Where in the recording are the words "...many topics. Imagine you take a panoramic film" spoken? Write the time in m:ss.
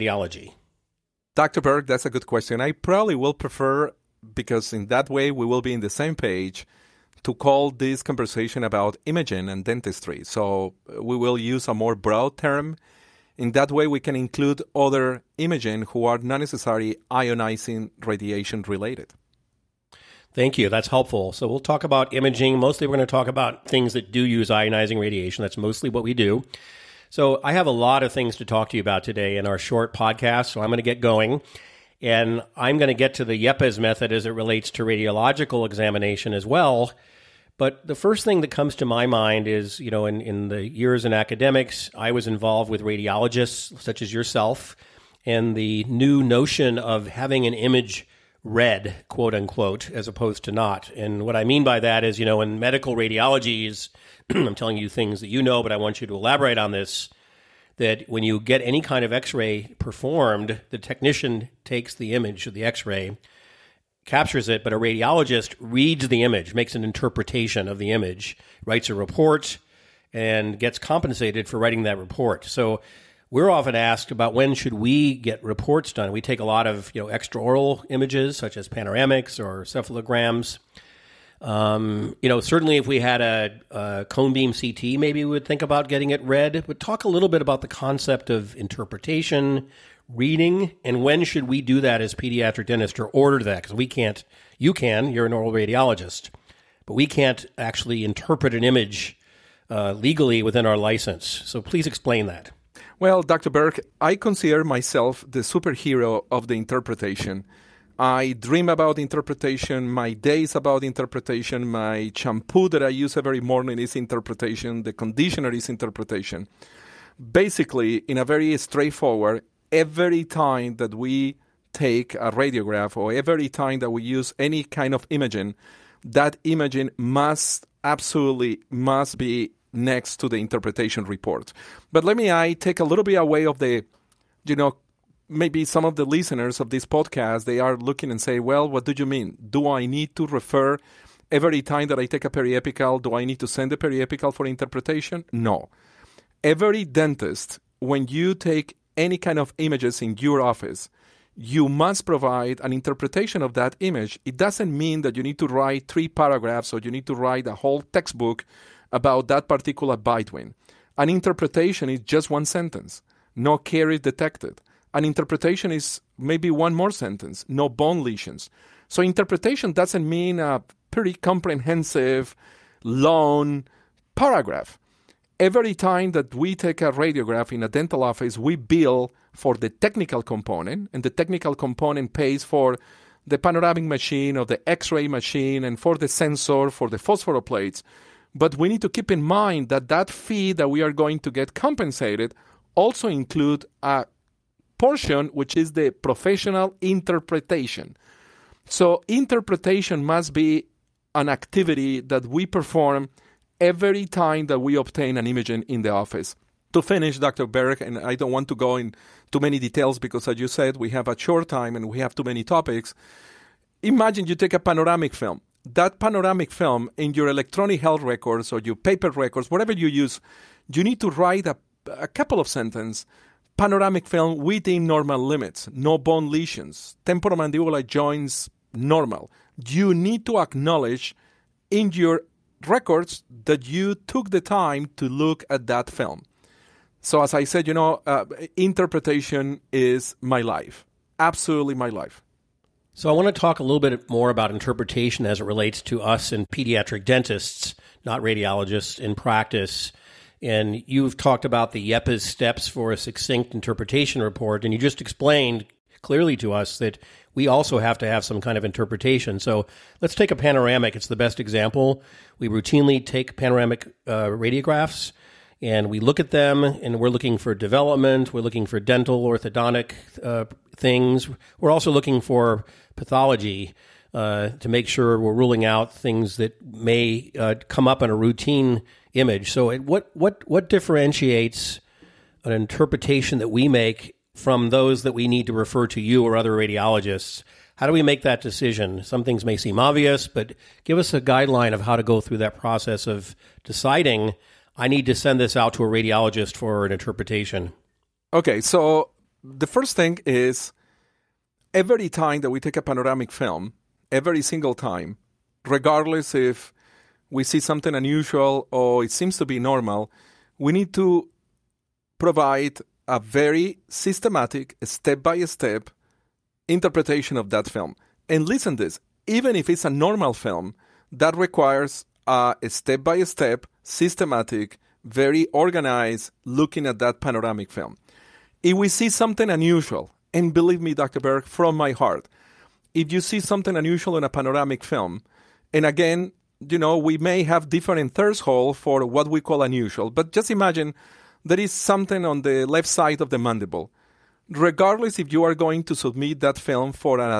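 3:32.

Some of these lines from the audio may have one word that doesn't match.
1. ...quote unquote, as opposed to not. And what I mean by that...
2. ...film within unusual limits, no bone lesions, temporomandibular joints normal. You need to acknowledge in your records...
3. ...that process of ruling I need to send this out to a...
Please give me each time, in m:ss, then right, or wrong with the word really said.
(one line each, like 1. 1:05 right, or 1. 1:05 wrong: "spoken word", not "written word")
1. 0:49 right
2. 3:44 wrong: "normal", not "unusual"
3. 4:52 wrong: "deciding", not "ruling".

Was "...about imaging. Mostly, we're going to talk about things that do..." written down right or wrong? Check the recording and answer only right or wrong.
right.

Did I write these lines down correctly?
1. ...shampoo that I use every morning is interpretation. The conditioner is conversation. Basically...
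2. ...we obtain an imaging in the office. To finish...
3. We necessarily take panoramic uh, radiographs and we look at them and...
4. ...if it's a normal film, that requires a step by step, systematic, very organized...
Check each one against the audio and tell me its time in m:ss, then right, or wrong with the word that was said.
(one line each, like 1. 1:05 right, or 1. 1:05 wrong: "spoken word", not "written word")
1. 1:52 wrong: "interpretation", not "conversation"
2. 3:24 right
3. 4:22 wrong: "routinely", not "necessarily"
4. 5:19 right.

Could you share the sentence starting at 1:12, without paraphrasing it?
So we're often asked about when should we get reports done.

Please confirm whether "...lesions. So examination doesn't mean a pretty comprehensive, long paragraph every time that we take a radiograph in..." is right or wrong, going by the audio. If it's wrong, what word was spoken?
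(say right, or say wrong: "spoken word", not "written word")
wrong: "interpretation", not "examination".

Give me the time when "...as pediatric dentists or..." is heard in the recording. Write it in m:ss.
1:32.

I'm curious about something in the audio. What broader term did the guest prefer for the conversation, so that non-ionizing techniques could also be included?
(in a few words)
imaging and dentistry.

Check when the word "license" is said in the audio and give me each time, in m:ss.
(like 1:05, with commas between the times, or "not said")
1:40.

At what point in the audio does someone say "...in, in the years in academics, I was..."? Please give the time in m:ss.
0:40.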